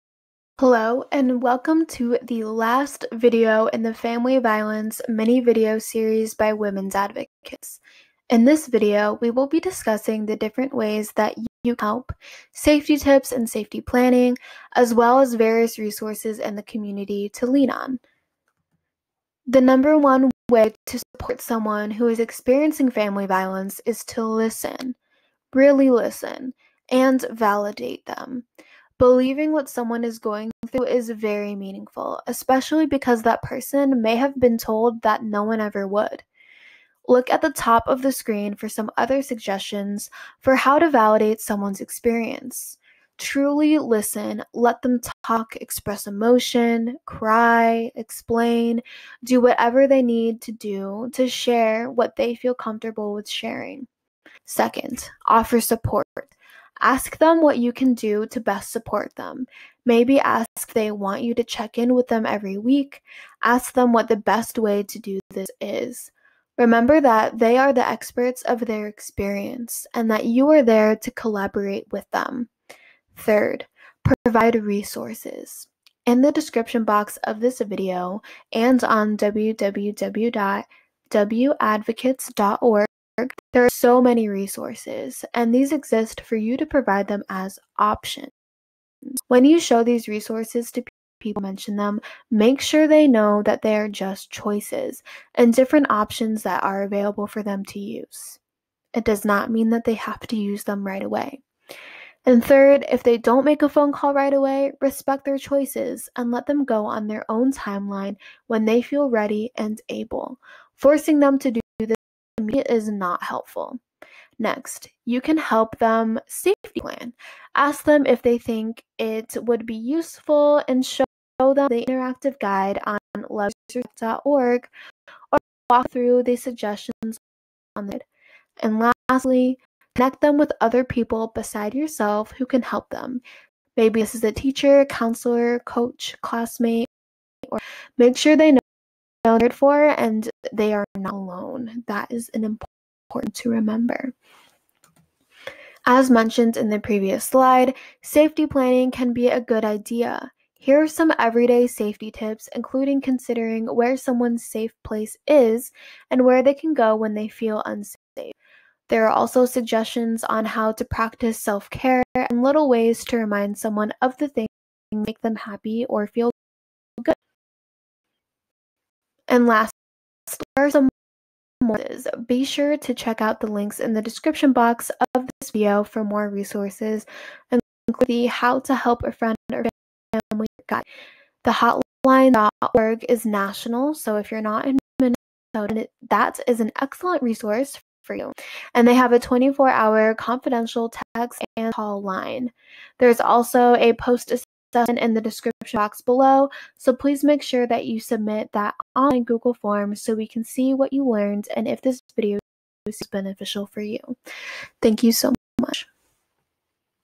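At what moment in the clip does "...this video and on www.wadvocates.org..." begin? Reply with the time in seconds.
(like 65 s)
77 s.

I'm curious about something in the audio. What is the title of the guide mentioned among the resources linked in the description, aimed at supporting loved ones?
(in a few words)
How to Help a Friend or Family Guide.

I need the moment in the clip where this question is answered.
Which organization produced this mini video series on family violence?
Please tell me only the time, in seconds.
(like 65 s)
6 s.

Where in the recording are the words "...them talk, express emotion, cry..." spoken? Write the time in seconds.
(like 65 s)
44 s.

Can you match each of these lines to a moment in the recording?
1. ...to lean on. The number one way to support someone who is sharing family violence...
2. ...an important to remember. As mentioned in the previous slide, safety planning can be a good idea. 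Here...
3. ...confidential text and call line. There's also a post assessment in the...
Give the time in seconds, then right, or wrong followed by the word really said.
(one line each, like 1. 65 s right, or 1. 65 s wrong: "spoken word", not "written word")
1. 17 s wrong: "experiencing", not "sharing"
2. 142 s right
3. 190 s right.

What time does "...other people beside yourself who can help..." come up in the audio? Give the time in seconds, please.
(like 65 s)
130 s.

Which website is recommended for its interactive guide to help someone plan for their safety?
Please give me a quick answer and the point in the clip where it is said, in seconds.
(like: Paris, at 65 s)
loveisrespect.org, at 123 s.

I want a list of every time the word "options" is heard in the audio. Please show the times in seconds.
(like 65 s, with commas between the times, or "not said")
87 s, 95 s.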